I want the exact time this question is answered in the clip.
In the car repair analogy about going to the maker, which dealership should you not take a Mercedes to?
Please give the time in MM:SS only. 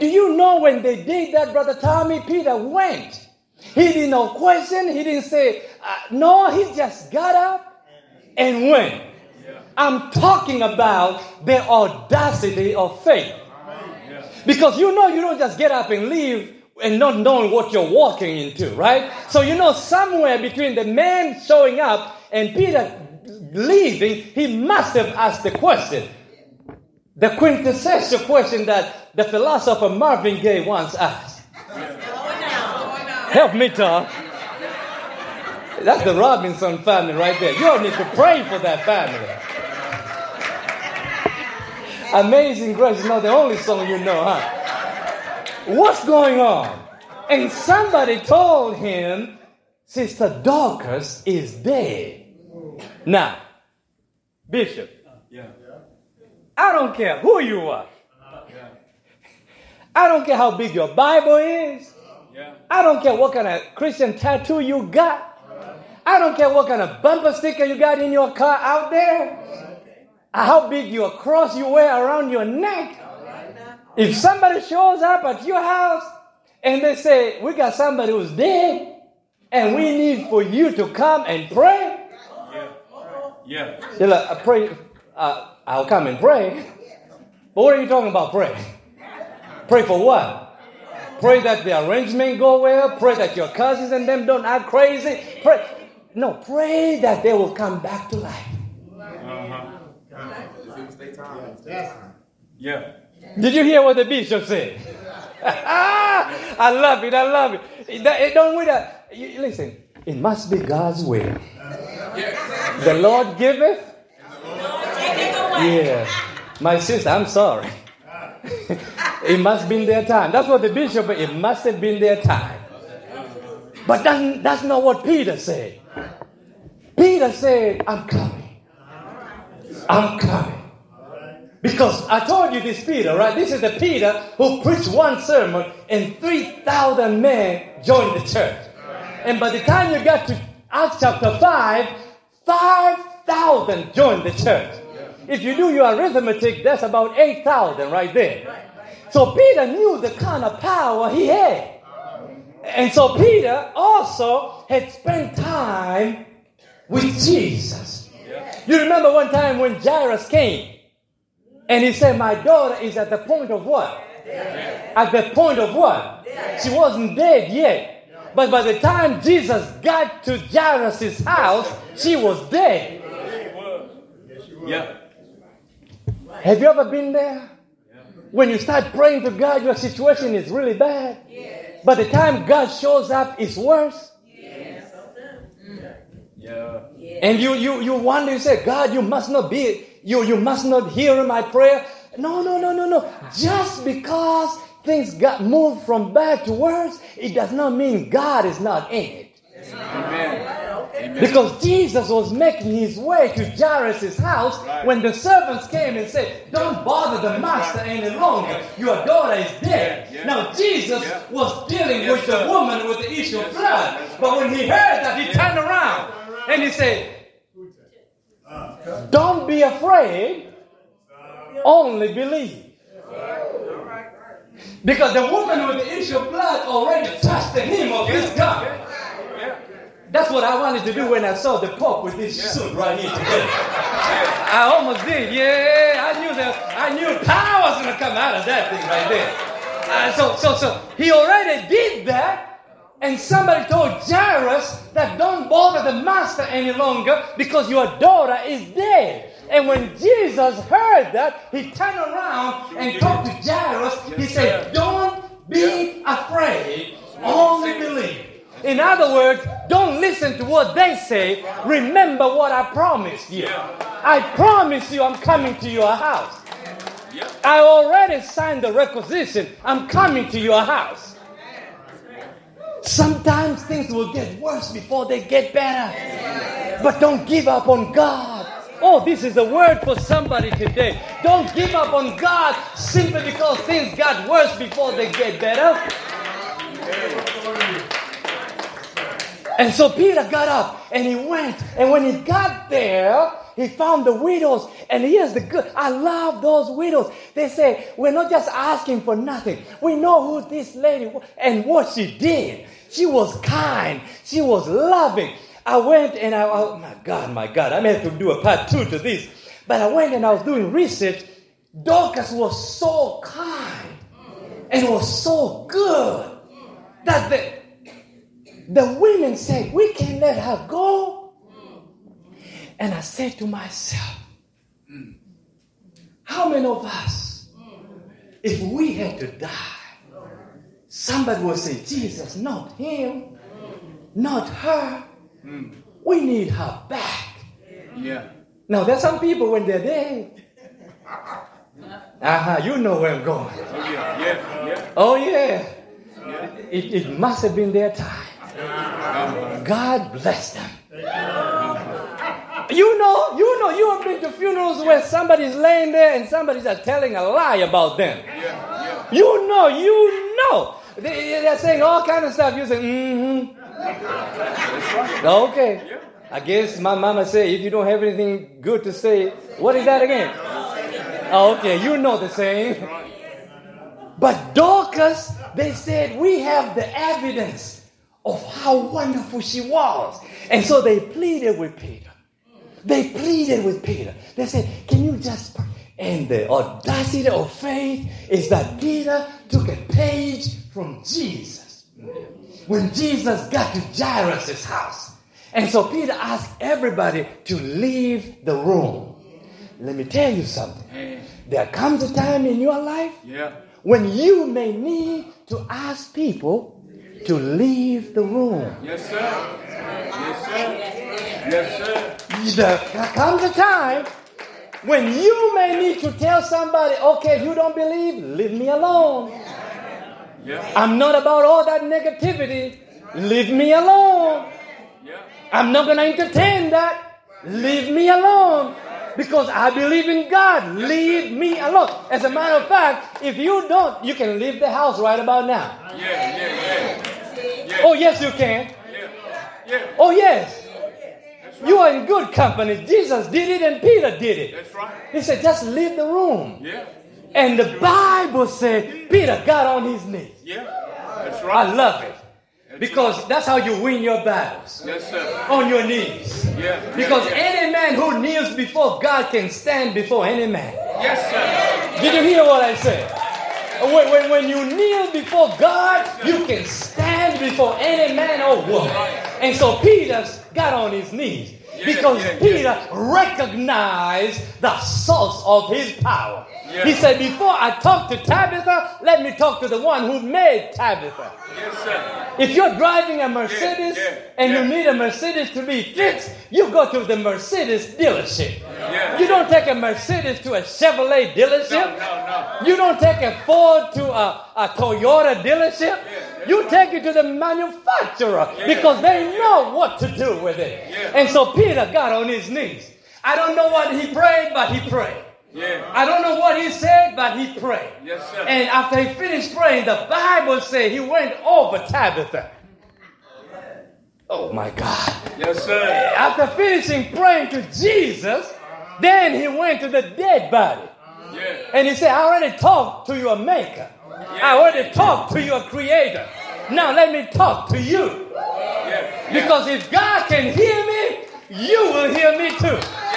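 08:10.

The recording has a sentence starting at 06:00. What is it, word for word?
They, are saying all kind of stuff.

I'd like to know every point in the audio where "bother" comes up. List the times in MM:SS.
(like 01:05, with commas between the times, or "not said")
03:26, 04:05.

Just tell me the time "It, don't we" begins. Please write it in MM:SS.
01:47.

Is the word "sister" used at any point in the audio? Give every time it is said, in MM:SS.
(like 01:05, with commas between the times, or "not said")
00:49, 01:56.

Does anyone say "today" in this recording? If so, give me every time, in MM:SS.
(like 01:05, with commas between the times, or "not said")
03:53, 04:40.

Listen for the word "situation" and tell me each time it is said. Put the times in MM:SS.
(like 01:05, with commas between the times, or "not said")
02:59.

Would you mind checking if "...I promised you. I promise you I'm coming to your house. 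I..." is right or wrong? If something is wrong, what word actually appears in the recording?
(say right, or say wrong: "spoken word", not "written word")
right.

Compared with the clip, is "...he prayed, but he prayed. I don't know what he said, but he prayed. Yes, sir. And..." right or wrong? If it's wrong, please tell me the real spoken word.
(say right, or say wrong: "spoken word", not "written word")
right.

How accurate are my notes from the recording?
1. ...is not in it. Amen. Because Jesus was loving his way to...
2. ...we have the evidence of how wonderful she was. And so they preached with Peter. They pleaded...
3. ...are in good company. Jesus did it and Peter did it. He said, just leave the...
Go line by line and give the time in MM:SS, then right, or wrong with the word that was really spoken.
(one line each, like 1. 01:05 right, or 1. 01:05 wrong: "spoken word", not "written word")
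1. 03:18 wrong: "making", not "loving"
2. 06:16 wrong: "pleaded", not "preached"
3. 07:21 right.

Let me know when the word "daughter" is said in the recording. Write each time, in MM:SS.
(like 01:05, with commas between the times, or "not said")
02:42, 03:29, 04:08.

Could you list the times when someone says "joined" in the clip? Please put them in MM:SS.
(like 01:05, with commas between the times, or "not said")
02:17, 02:23.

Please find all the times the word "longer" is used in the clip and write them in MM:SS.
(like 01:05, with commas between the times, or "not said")
03:28, 04:06.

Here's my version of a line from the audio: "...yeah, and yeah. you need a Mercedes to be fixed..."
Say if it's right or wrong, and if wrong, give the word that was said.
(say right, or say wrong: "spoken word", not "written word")
right.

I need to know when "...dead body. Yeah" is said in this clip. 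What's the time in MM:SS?
08:40.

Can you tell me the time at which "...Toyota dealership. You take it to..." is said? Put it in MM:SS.
08:14.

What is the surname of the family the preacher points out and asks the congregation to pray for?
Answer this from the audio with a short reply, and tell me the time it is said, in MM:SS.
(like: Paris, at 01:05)
Robinson, at 00:36.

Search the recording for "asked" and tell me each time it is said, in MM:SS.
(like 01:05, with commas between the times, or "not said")
00:25, 00:30, 06:36.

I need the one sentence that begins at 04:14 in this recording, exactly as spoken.
He said, Don't be afraid, only believe.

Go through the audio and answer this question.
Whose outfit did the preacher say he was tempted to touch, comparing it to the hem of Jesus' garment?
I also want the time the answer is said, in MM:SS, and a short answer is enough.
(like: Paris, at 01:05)
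the Pope, at 03:51.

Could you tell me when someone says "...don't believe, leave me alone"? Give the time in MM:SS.
06:57.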